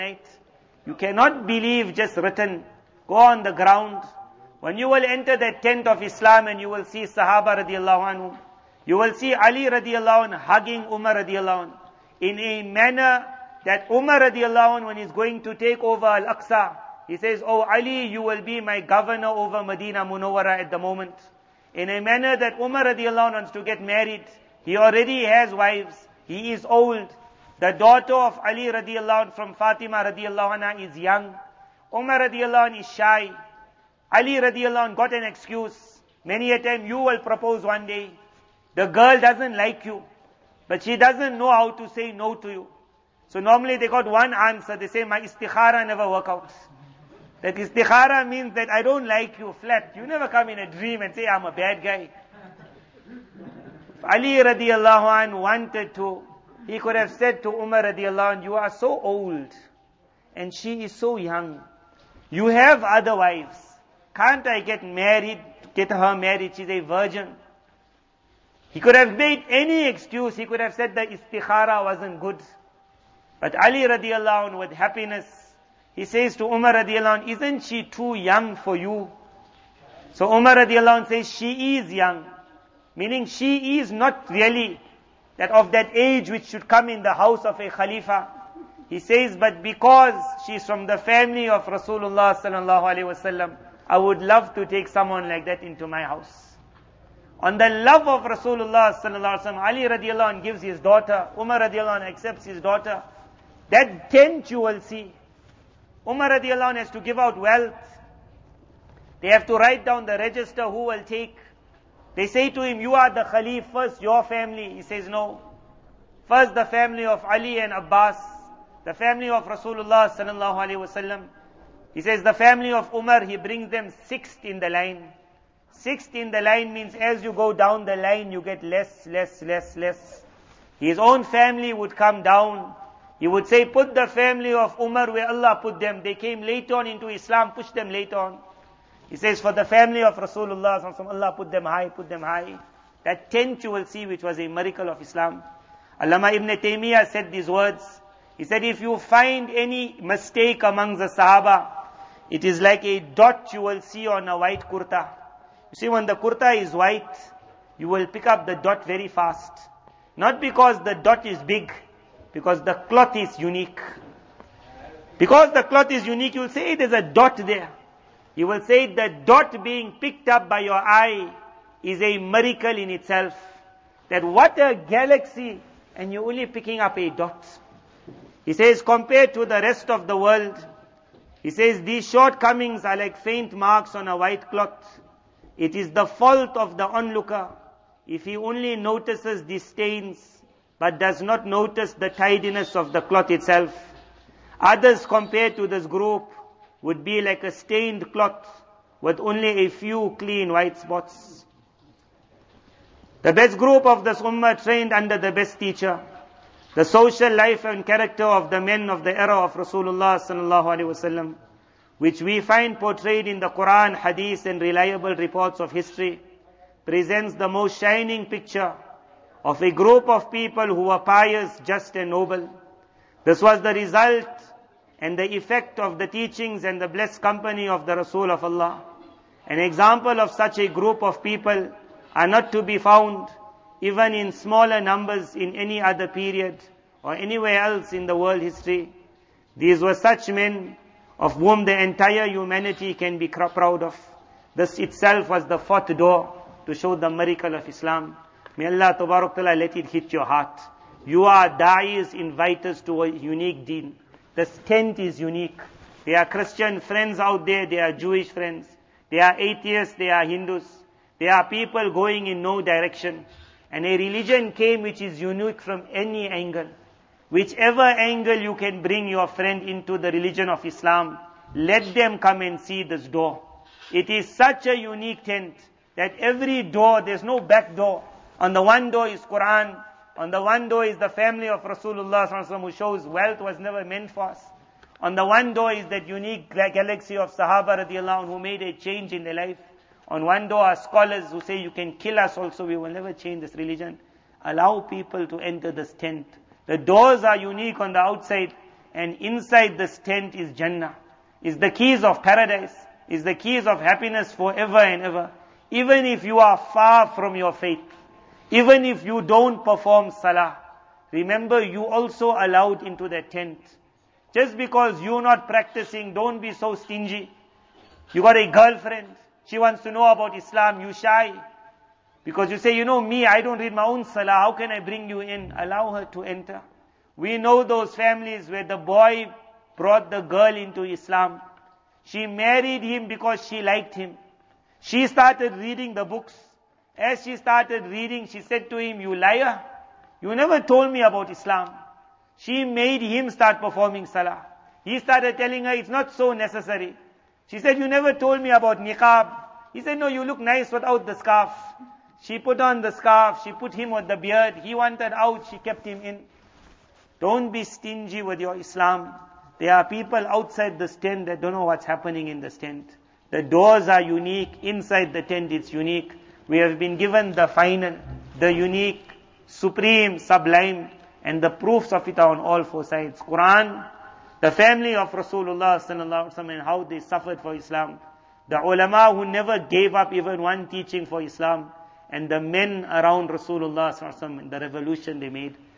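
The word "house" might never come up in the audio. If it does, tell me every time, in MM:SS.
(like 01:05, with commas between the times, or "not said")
01:27, 01:36.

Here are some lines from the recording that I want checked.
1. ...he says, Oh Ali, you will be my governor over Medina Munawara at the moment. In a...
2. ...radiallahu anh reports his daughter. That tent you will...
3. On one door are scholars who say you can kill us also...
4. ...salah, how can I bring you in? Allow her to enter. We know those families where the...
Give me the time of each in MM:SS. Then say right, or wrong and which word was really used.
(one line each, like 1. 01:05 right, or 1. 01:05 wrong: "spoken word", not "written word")
1. 00:17 right
2. 01:41 wrong: "accepts", not "reports"
3. 04:50 right
4. 05:24 right.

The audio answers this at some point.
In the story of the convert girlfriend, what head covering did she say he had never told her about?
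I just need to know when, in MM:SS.
05:48.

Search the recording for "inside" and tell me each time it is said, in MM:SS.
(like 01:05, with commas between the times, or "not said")
04:59, 06:04.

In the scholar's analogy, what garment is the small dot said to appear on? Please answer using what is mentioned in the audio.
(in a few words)
A white kurta.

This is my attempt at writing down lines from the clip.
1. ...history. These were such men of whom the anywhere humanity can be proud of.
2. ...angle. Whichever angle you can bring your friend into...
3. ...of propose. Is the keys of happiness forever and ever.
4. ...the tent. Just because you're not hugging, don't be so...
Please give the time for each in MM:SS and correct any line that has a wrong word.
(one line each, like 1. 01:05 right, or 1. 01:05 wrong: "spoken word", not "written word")
1. 03:58 wrong: "entire", not "anywhere"
2. 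04:26 right
3. 05:02 wrong: "paradise", not "propose"
4. 05:13 wrong: "practicing", not "hugging".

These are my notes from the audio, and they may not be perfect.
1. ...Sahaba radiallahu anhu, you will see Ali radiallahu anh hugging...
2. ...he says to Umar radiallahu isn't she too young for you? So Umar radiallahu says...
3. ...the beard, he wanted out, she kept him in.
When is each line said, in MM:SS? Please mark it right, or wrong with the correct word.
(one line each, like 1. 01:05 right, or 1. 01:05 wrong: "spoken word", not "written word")
1. 00:07 right
2. 01:15 right
3. 05:54 right.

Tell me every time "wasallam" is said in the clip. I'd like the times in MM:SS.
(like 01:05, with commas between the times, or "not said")
01:33, 01:39, 02:00, 03:30, 06:16.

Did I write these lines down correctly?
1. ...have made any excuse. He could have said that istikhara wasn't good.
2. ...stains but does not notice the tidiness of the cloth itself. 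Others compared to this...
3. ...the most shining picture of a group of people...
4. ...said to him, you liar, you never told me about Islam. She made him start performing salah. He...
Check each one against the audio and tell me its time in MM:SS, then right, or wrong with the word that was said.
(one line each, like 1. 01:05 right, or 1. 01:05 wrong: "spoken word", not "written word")
1. 01:08 right
2. 03:09 right
3. 03:37 right
4. 05:38 right.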